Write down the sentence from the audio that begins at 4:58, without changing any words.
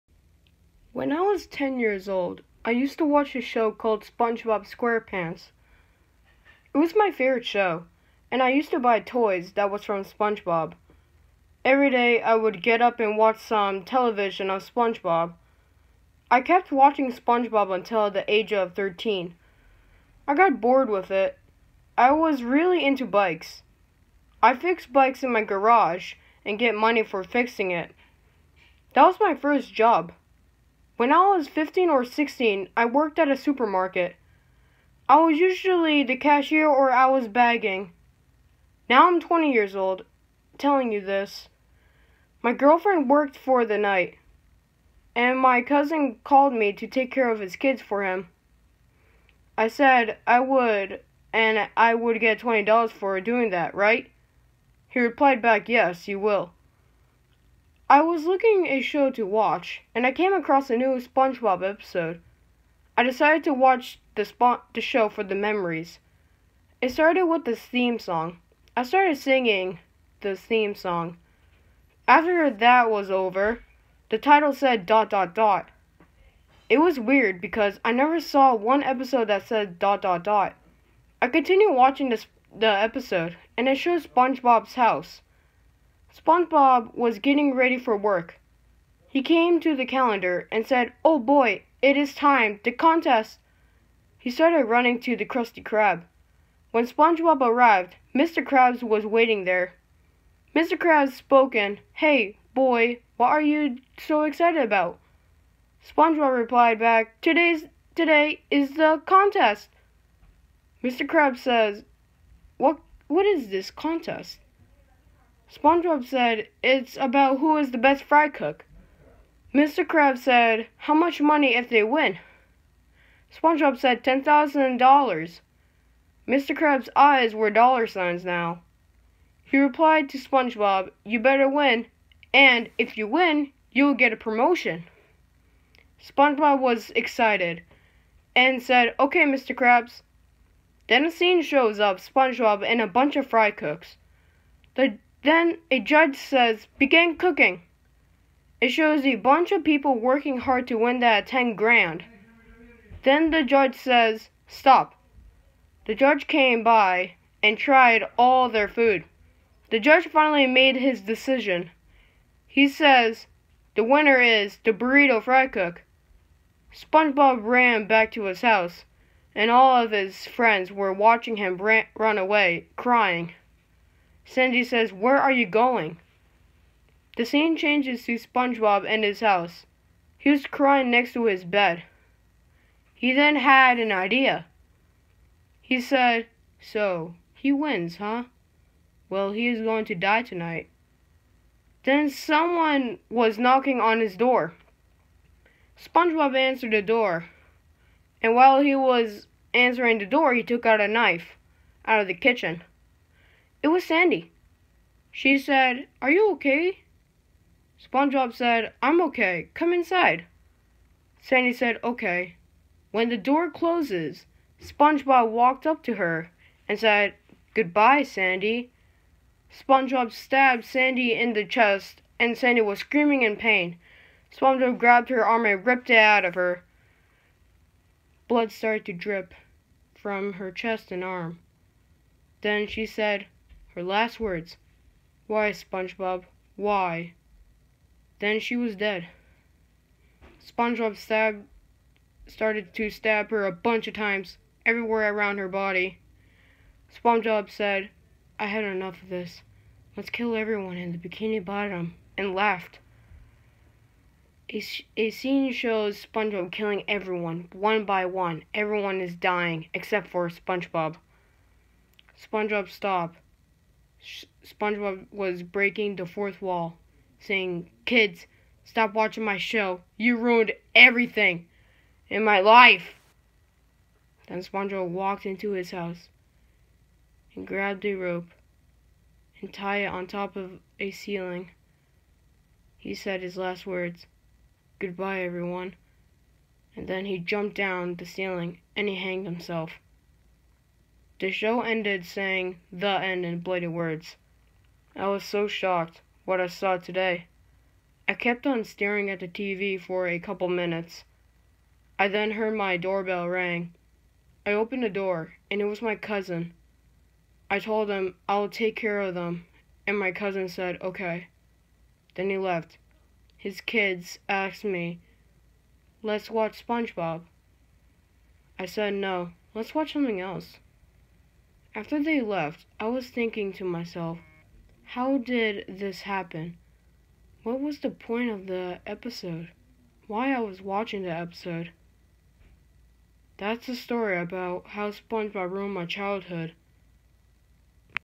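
I kept on staring at the TV for a couple minutes.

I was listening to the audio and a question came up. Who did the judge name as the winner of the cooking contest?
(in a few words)
The burrito fry cook.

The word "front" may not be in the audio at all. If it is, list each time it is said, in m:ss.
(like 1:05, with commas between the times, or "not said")
not said.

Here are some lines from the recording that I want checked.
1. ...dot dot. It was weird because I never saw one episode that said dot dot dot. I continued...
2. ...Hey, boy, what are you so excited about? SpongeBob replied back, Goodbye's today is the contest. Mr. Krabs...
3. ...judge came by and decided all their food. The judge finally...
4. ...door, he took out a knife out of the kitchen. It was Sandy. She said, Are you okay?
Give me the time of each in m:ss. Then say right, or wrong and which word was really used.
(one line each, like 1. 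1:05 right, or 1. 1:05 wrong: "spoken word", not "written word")
1. 1:15 right
2. 1:41 wrong: "Today", not "Goodbye"
3. 2:35 wrong: "tried", not "decided"
4. 3:20 right.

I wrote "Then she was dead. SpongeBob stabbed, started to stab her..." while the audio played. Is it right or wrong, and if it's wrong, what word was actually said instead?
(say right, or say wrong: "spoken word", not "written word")
right.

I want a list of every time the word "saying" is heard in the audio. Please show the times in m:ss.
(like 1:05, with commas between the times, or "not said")
4:27, 4:52.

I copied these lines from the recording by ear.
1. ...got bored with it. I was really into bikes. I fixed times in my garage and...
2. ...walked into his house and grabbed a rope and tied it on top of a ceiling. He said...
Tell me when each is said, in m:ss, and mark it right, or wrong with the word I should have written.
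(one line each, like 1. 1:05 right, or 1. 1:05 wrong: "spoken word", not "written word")
1. 0:20 wrong: "bikes", not "times"
2. 4:34 right.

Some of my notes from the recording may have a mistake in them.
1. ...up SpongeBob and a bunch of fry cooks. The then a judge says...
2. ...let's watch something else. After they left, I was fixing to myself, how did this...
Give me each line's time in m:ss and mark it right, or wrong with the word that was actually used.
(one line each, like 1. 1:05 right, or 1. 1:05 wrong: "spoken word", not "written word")
1. 2:21 right
2. 5:19 wrong: "thinking", not "fixing".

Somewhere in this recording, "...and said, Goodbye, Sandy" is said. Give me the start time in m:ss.
3:36.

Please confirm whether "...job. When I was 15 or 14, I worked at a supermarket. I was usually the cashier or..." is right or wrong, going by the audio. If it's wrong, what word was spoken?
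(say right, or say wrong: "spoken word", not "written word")
wrong: "16", not "14".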